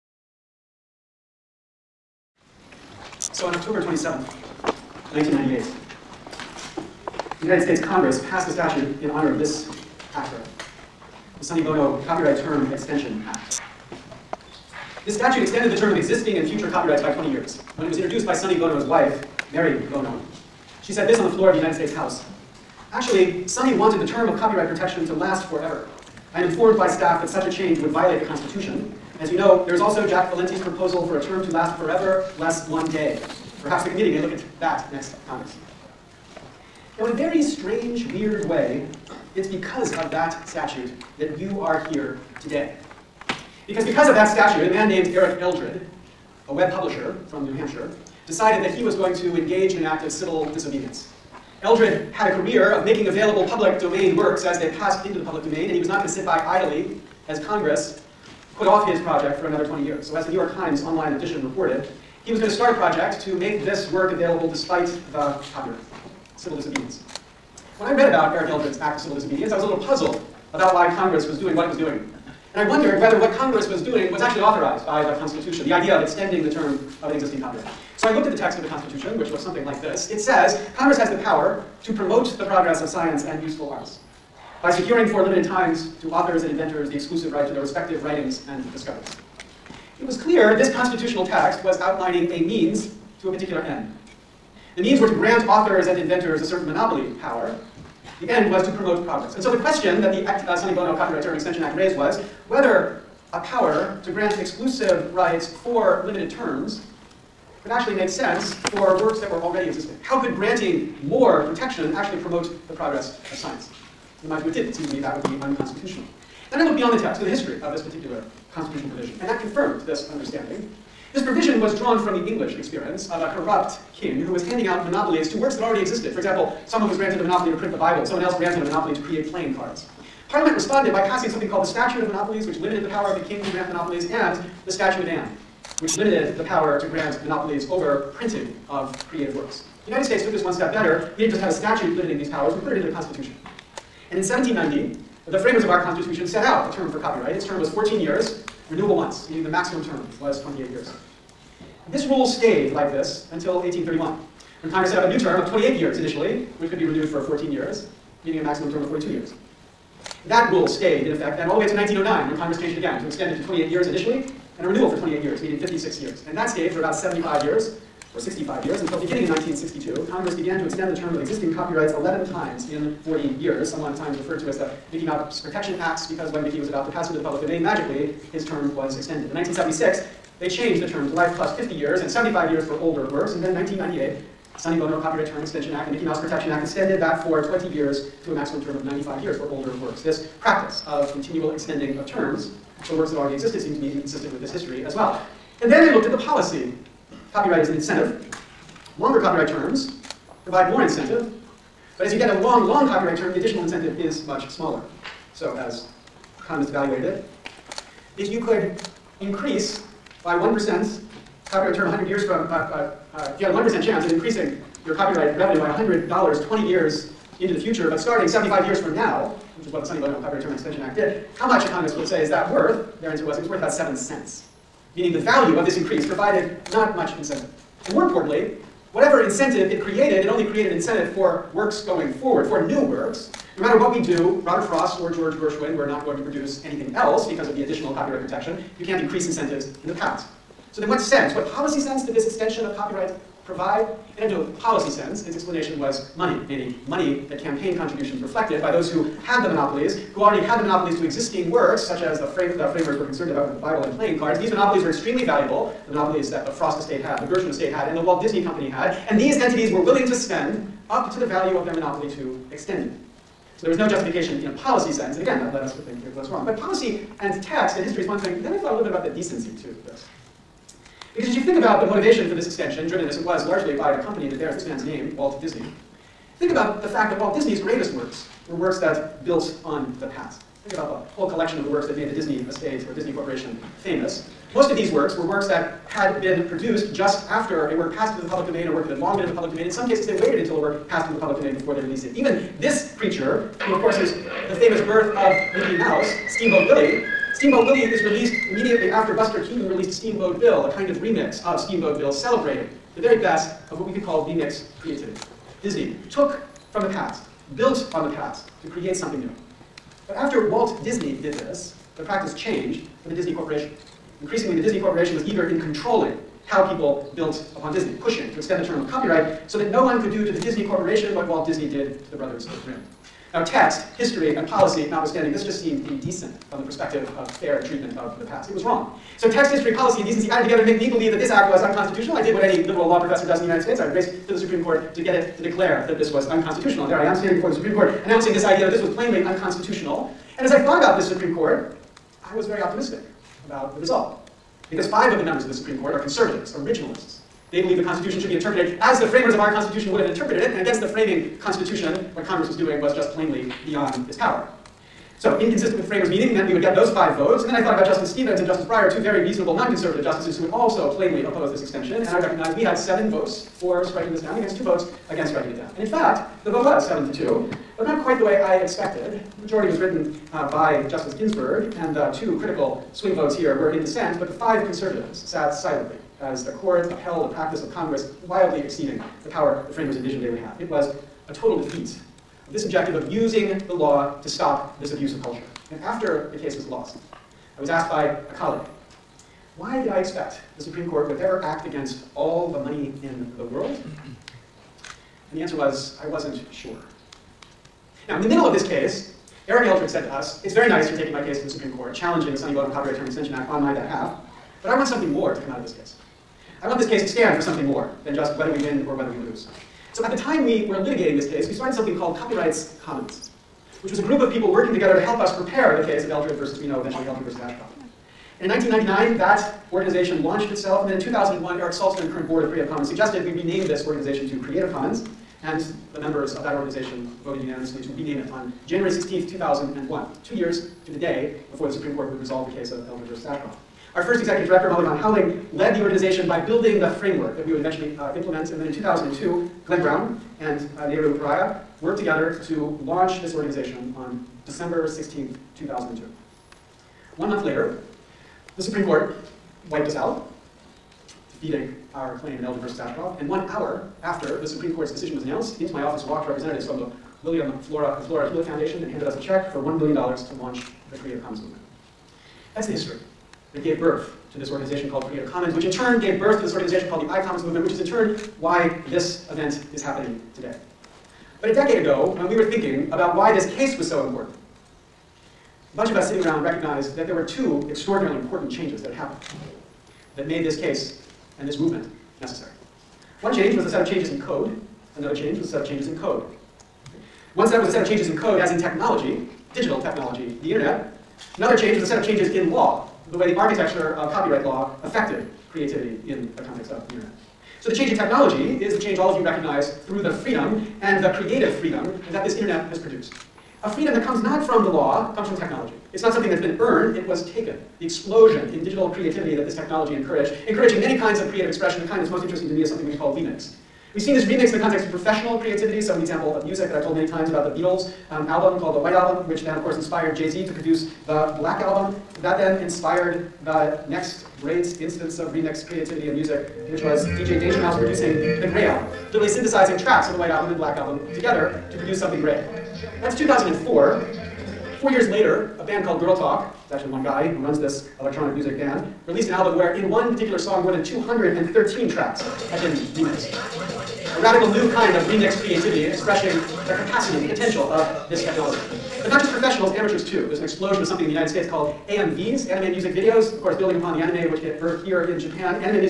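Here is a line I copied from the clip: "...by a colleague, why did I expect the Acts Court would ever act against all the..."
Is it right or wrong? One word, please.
wrong.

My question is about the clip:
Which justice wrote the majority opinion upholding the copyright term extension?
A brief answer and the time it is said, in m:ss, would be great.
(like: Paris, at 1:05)
Justice Ginsburg, at 6:10.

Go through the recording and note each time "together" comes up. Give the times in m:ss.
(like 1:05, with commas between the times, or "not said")
5:30, 6:54, 7:21, 8:51.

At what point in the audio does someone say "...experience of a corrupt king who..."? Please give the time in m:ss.
2:02.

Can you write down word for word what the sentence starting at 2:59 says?
In 1976, they changed the term to life plus 50 years and 75 years for older works.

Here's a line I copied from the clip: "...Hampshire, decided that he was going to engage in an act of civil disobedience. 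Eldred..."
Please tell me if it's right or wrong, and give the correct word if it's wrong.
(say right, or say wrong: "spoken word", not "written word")
right.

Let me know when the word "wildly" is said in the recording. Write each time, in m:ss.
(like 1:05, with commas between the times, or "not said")
6:18.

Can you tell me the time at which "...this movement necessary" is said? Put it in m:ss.
8:01.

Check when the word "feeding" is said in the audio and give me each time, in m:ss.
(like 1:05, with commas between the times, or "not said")
not said.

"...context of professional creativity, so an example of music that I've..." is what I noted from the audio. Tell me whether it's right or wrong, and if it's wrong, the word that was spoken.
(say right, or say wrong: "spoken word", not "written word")
right.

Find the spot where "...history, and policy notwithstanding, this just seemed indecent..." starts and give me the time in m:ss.
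5:23.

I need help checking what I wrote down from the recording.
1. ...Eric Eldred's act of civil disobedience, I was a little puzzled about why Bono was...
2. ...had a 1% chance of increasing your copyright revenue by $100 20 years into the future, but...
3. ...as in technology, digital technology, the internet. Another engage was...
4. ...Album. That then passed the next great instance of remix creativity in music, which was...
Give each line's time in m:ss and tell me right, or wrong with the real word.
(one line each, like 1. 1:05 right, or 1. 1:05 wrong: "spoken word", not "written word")
1. 1:08 wrong: "Congress", not "Bono"
2. 3:33 right
3. 8:08 wrong: "change", not "engage"
4. 8:41 wrong: "inspired", not "passed".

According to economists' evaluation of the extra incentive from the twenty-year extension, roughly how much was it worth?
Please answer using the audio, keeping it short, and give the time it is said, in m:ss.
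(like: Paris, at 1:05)
7 cents, at 3:43.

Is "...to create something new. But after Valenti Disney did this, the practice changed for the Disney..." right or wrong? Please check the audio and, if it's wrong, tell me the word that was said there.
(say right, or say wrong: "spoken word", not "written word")
wrong: "Walt", not "Valenti".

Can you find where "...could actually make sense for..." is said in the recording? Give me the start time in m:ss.
1:47.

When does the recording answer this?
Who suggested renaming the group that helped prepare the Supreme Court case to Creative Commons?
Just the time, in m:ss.
7:01.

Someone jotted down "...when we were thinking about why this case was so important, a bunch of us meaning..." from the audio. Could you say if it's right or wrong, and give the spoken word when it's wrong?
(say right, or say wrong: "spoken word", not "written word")
wrong: "sitting", not "meaning".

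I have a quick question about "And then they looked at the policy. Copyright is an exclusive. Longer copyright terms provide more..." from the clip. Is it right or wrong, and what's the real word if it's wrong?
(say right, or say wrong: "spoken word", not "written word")
wrong: "incentive", not "exclusive".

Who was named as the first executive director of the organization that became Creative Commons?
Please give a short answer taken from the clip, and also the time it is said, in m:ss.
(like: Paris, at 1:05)
Molly Van Houweling, at 7:14.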